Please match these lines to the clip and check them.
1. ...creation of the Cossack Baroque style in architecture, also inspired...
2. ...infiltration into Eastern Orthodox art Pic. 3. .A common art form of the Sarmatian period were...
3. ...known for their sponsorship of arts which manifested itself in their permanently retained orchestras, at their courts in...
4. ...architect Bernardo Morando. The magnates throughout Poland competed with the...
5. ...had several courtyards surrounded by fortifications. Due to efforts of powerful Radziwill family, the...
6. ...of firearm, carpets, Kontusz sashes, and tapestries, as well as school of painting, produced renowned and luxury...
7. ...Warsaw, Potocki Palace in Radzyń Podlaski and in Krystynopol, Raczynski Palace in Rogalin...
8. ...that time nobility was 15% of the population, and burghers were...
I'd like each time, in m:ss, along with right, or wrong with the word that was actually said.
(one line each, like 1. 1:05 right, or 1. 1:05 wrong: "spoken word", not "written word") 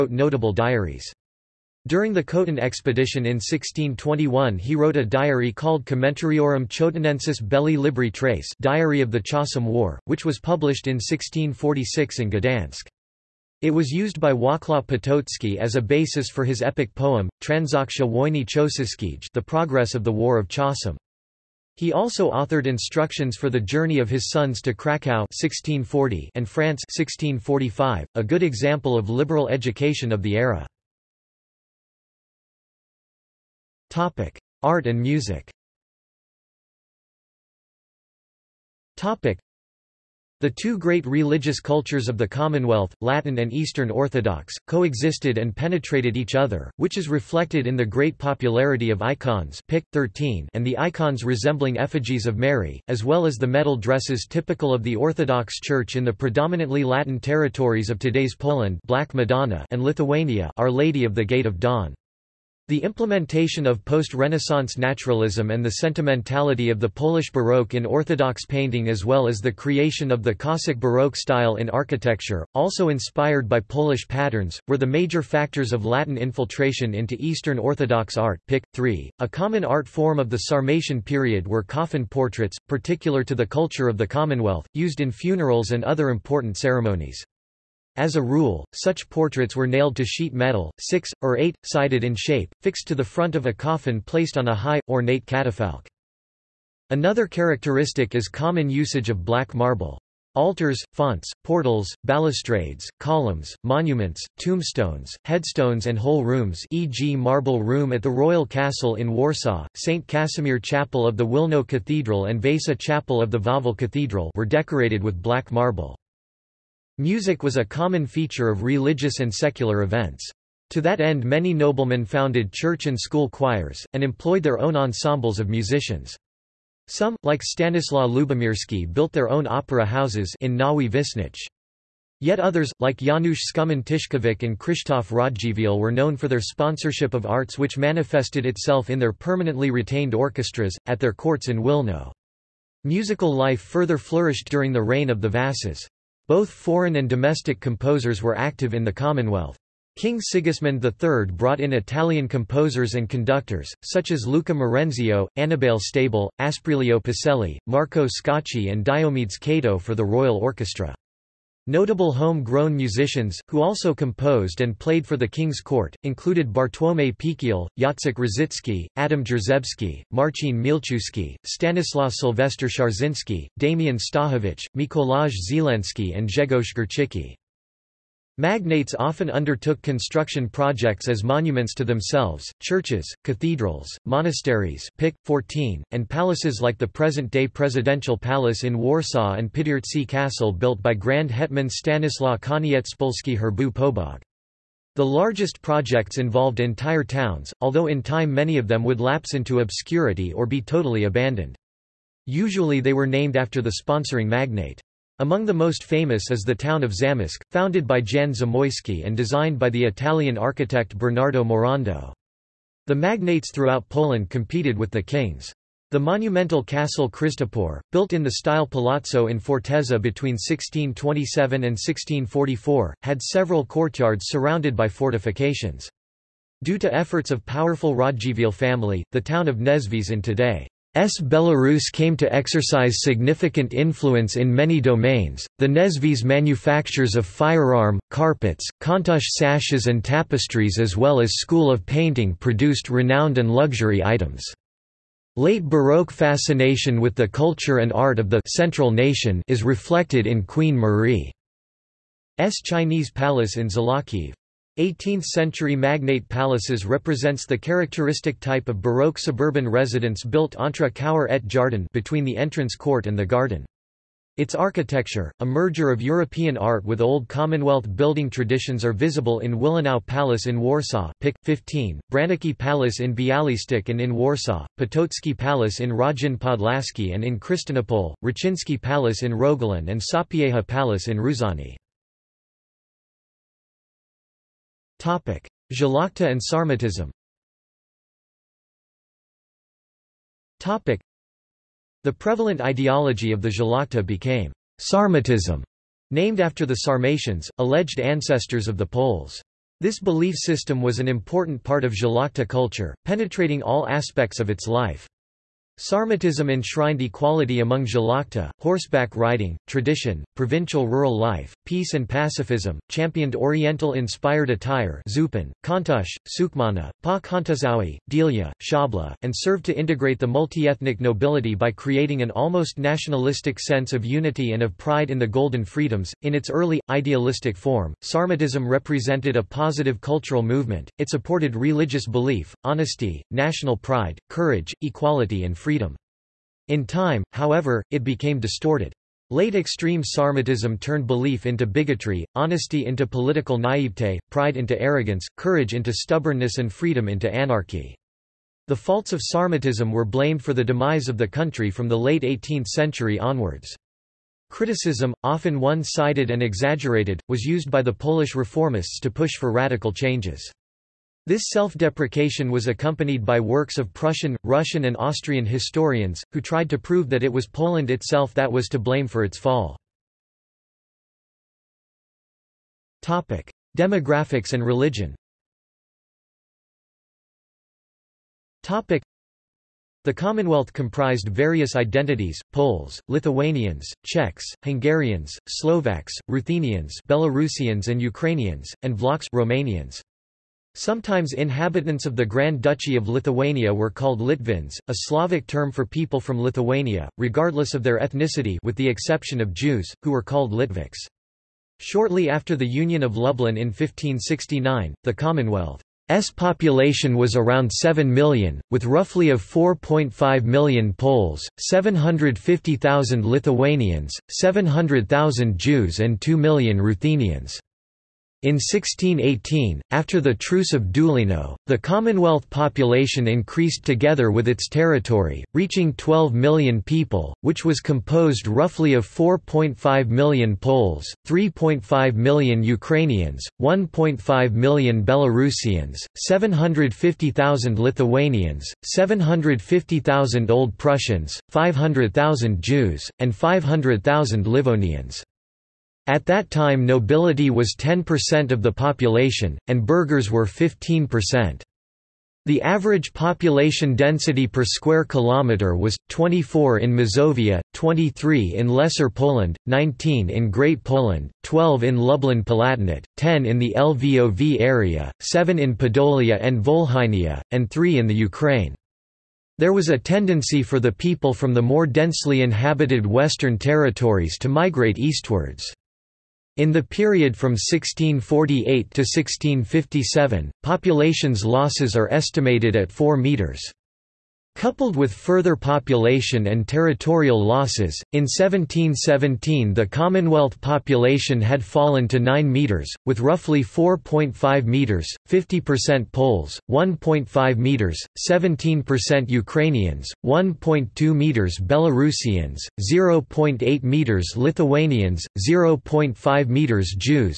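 1. 1:09 right
2. 1:16 right
3. 2:15 right
4. 3:30 right
5. 3:43 right
6. 3:57 right
7. 4:34 right
8. 7:26 wrong: "10", not "15".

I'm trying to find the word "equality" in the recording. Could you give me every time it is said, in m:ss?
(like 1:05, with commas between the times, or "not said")
5:07, 5:34.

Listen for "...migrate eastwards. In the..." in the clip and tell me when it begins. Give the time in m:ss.
7:54.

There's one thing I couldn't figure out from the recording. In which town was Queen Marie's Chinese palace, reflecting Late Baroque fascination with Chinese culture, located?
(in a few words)
Zolochiv.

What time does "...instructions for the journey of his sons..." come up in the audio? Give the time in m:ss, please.
0:22.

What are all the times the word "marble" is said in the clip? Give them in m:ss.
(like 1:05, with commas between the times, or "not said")
1:39, 1:47, 1:55.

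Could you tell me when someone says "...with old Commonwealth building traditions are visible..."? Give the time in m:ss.
4:26.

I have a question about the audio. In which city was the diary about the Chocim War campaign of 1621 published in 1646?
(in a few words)
Gdansk.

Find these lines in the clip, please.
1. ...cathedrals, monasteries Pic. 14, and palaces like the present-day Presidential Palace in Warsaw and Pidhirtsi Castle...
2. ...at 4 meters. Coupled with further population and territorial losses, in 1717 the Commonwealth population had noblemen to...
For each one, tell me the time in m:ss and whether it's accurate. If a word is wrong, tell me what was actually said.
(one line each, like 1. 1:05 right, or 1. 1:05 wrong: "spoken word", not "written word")
1. 3:03 right
2. 8:02 wrong: "fallen", not "noblemen".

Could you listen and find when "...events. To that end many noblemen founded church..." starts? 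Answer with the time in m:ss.
1:59.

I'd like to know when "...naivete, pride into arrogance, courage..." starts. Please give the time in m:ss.
5:43.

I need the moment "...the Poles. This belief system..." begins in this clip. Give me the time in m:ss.
4:58.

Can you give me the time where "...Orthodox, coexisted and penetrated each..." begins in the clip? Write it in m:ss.
0:43.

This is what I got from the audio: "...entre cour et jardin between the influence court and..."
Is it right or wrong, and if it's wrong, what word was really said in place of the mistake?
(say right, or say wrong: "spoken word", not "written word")
wrong: "entrance", not "influence".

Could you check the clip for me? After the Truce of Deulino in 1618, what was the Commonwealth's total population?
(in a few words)
12 million.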